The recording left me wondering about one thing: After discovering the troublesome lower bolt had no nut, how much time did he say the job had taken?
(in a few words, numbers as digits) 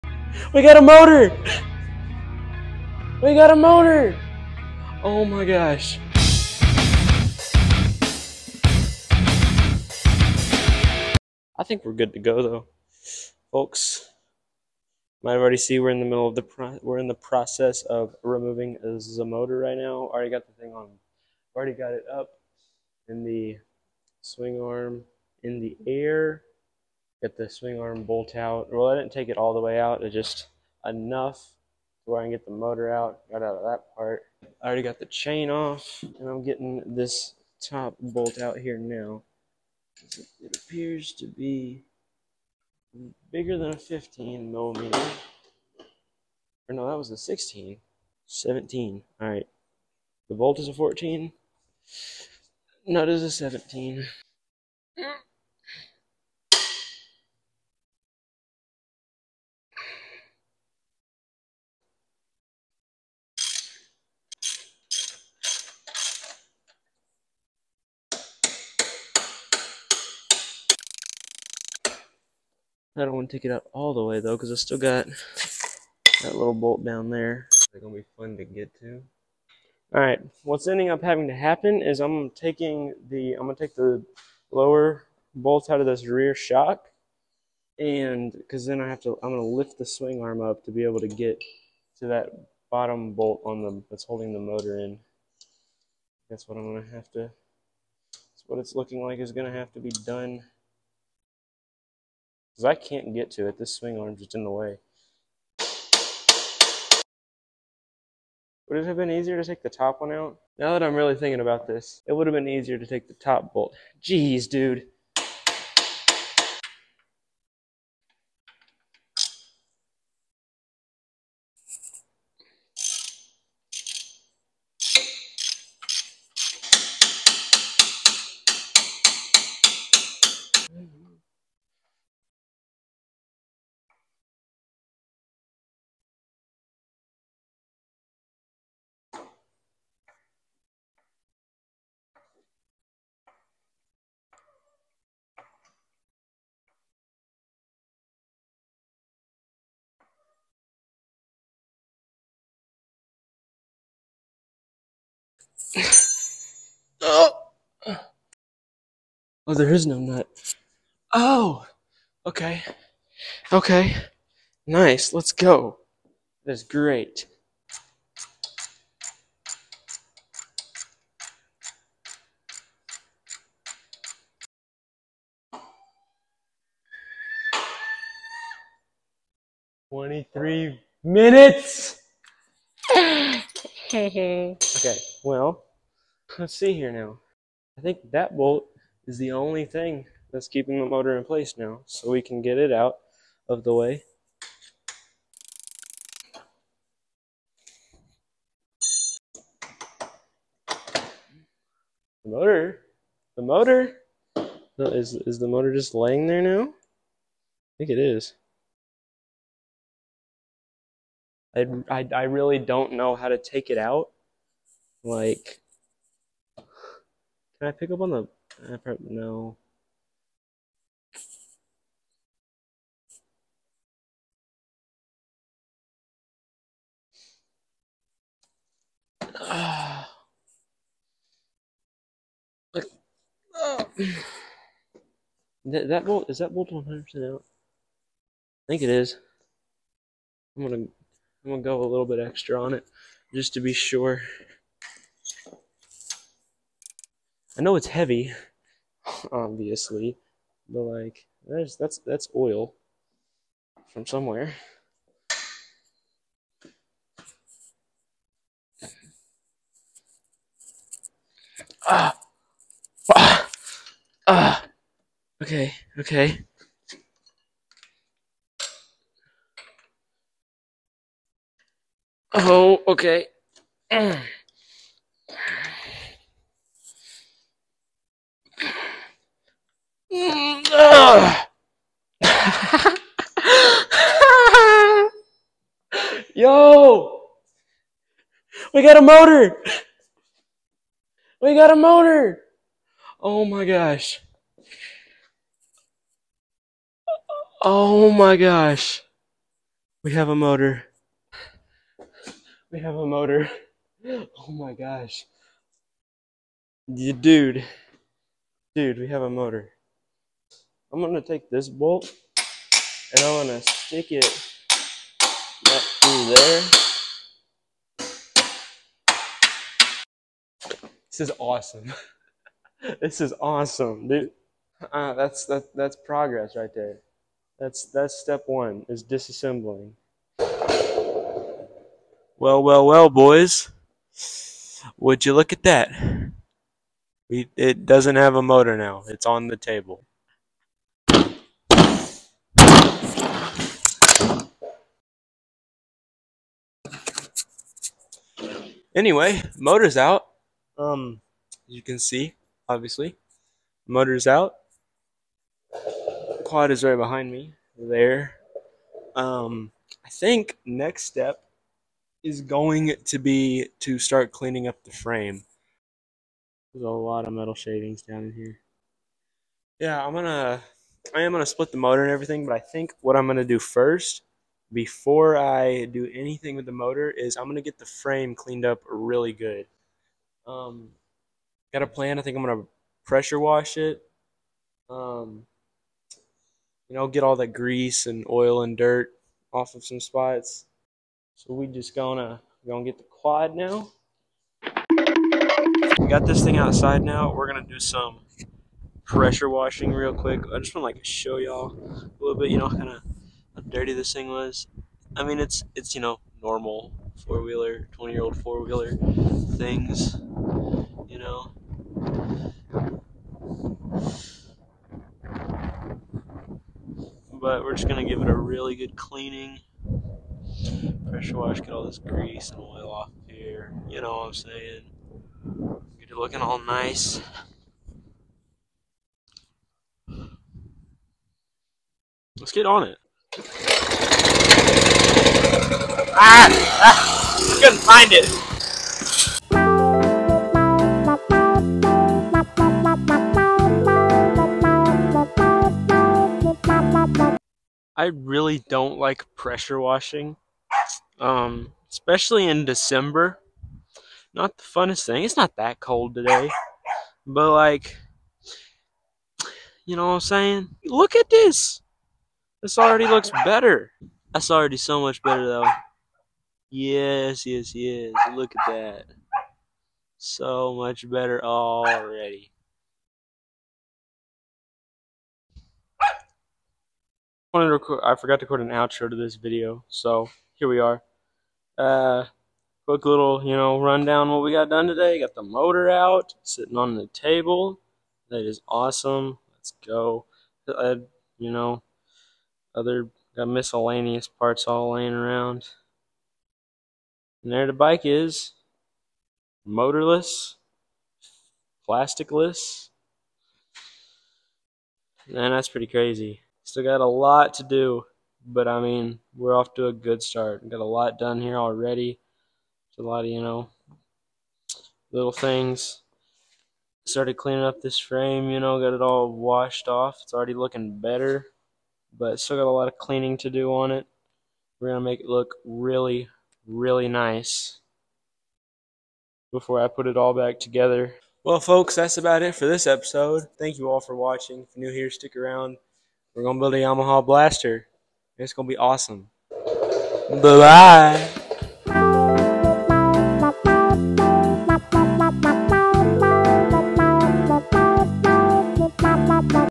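23 minutes.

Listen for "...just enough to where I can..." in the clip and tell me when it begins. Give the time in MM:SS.
00:30.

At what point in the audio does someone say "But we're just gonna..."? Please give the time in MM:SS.
06:57.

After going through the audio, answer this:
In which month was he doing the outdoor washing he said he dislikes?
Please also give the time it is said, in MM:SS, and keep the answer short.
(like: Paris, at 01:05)
December, at 07:32.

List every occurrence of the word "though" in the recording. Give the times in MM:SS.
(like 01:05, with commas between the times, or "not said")
00:12, 01:14, 07:45.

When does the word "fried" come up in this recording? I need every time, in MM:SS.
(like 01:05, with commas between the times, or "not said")
not said.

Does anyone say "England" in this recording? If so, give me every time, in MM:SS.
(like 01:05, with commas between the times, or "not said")
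not said.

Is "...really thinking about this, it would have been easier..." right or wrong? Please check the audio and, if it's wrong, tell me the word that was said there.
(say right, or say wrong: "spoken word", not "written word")
right.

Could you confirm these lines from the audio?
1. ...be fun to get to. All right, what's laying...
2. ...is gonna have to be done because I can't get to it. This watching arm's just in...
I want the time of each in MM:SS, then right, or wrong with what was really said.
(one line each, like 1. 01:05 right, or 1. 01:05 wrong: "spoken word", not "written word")
1. 01:17 wrong: "ending", not "laying"
2. 01:39 wrong: "swing", not "watching".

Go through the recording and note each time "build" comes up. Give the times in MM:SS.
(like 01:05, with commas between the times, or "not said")
08:56.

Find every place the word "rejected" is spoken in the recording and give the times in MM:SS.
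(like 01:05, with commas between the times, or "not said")
not said.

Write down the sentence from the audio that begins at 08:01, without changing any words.
Uh, quick little, you know, rundown what we got done today.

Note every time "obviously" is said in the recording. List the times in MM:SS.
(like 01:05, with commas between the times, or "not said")
04:09, 05:52.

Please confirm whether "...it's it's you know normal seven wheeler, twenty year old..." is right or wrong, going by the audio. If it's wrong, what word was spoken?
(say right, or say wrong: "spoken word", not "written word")
wrong: "four", not "seven".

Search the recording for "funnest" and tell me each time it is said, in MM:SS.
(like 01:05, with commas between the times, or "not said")
07:34.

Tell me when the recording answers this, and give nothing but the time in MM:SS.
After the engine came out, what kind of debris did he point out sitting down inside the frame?
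06:07.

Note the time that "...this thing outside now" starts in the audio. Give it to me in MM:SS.
06:36.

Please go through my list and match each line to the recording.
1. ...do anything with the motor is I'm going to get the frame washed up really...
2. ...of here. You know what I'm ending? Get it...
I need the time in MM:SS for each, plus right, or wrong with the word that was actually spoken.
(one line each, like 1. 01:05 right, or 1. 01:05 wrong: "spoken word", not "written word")
1. 06:15 wrong: "cleaned", not "washed"
2. 07:03 wrong: "saying", not "ending".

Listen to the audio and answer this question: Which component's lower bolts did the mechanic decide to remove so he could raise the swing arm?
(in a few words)
rear shock.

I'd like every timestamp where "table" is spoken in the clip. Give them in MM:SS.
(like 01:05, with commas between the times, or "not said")
05:39, 08:07.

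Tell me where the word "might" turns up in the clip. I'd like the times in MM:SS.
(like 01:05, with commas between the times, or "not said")
00:15.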